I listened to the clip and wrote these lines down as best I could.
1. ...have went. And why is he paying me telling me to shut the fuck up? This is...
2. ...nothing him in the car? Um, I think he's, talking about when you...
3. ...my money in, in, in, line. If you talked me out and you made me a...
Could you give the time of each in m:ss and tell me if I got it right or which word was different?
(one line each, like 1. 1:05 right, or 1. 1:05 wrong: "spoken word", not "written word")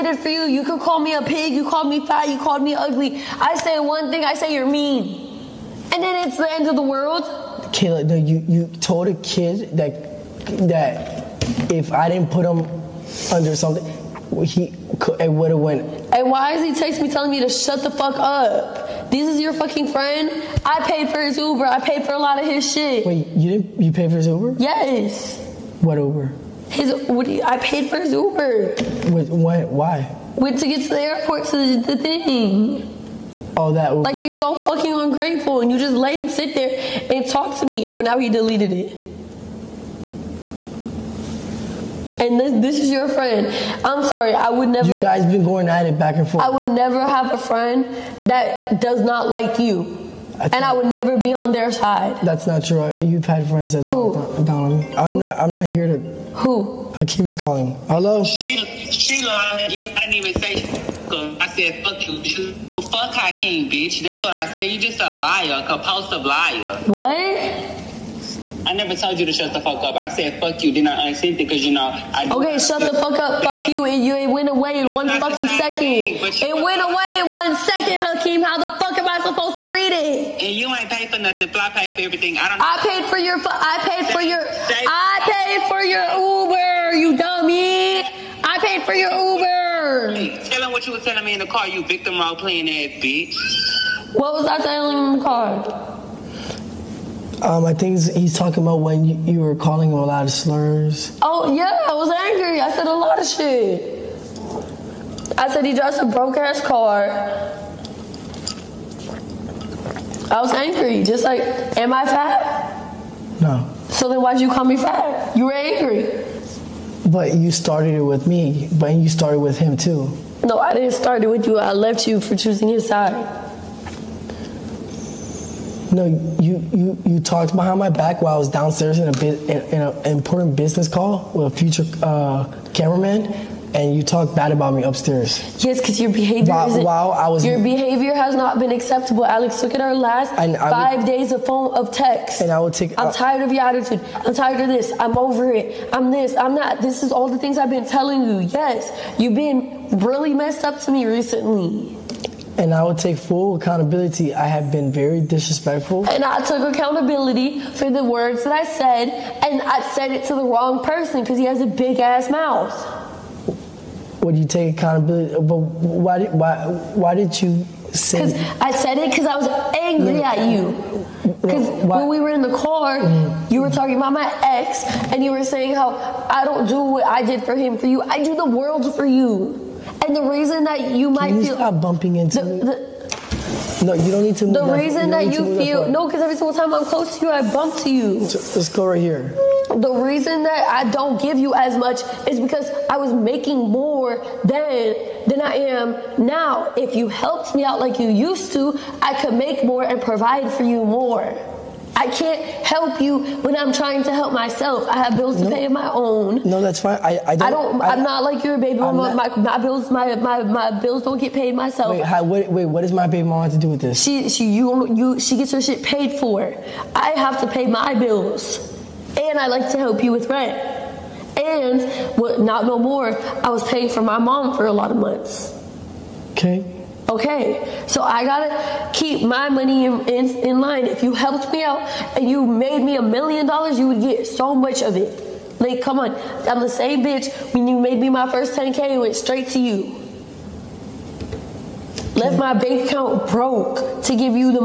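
1. 0:15 wrong: "texting", not "paying"
2. 1:34 wrong: "telling", not "nothing"
3. 3:49 wrong: "helped", not "talked".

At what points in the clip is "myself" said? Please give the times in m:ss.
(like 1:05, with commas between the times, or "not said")
3:24, 3:31.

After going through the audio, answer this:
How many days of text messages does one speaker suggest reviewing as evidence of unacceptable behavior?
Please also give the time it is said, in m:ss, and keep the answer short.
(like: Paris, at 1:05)
5, at 2:20.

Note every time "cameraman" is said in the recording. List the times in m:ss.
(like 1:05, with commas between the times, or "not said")
2:12.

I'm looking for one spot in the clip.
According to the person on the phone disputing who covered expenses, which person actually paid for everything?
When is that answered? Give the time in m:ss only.
1:21.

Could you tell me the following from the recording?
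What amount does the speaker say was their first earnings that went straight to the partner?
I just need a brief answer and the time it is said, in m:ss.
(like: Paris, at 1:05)
$10K, at 3:58.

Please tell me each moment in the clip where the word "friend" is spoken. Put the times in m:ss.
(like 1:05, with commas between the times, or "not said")
0:19, 0:43, 0:47, 0:53.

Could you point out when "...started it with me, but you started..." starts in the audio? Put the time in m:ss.
1:57.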